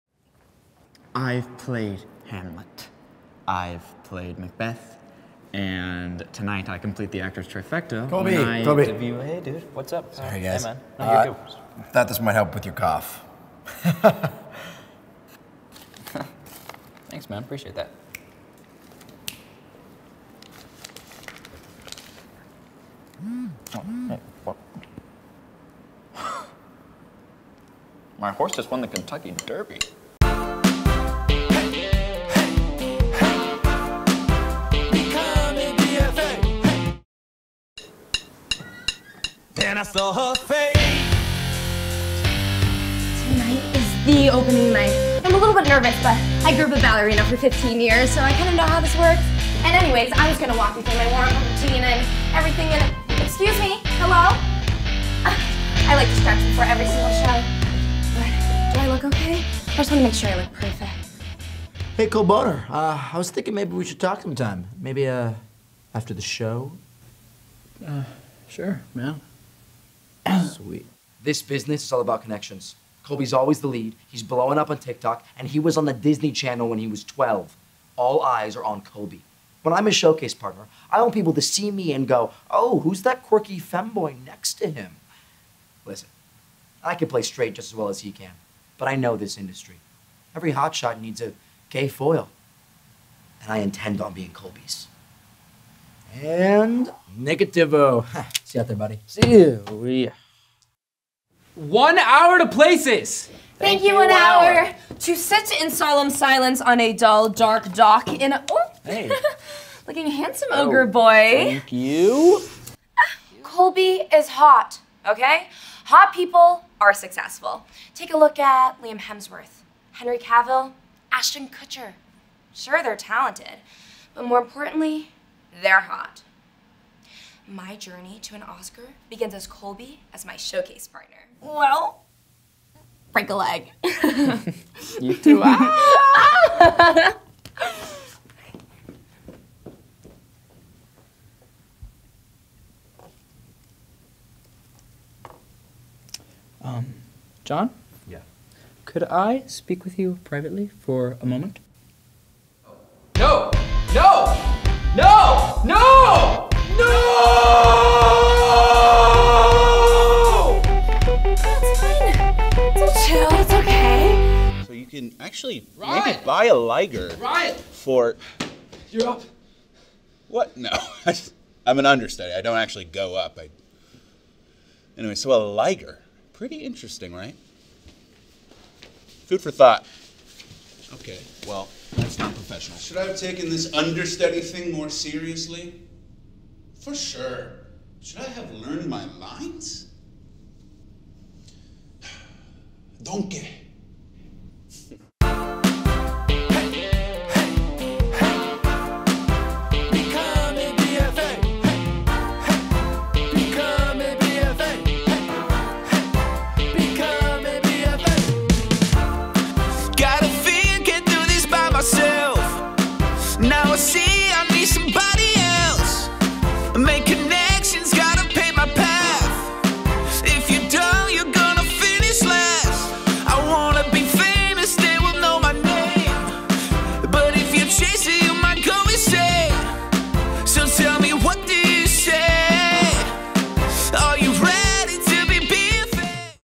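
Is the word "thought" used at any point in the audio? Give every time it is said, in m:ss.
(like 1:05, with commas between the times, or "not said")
0:11, 2:59.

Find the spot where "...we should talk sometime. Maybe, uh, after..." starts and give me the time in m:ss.
1:03.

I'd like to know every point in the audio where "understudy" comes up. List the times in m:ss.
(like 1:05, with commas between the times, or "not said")
2:51, 3:03.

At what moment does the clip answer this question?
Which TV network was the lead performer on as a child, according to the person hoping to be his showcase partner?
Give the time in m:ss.
1:15.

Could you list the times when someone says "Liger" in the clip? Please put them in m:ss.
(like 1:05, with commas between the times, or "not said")
2:46, 2:55.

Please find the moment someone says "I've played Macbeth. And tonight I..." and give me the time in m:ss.
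0:03.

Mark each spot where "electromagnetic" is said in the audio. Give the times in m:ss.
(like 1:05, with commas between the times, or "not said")
not said.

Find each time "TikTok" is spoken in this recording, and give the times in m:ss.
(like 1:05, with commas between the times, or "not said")
1:14.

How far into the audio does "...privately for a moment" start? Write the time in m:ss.
2:30.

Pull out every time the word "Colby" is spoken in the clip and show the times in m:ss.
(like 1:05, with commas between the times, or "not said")
0:08, 1:13, 1:18, 1:34, 1:53, 2:09.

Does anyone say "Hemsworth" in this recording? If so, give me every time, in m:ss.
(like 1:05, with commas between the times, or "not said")
1:58.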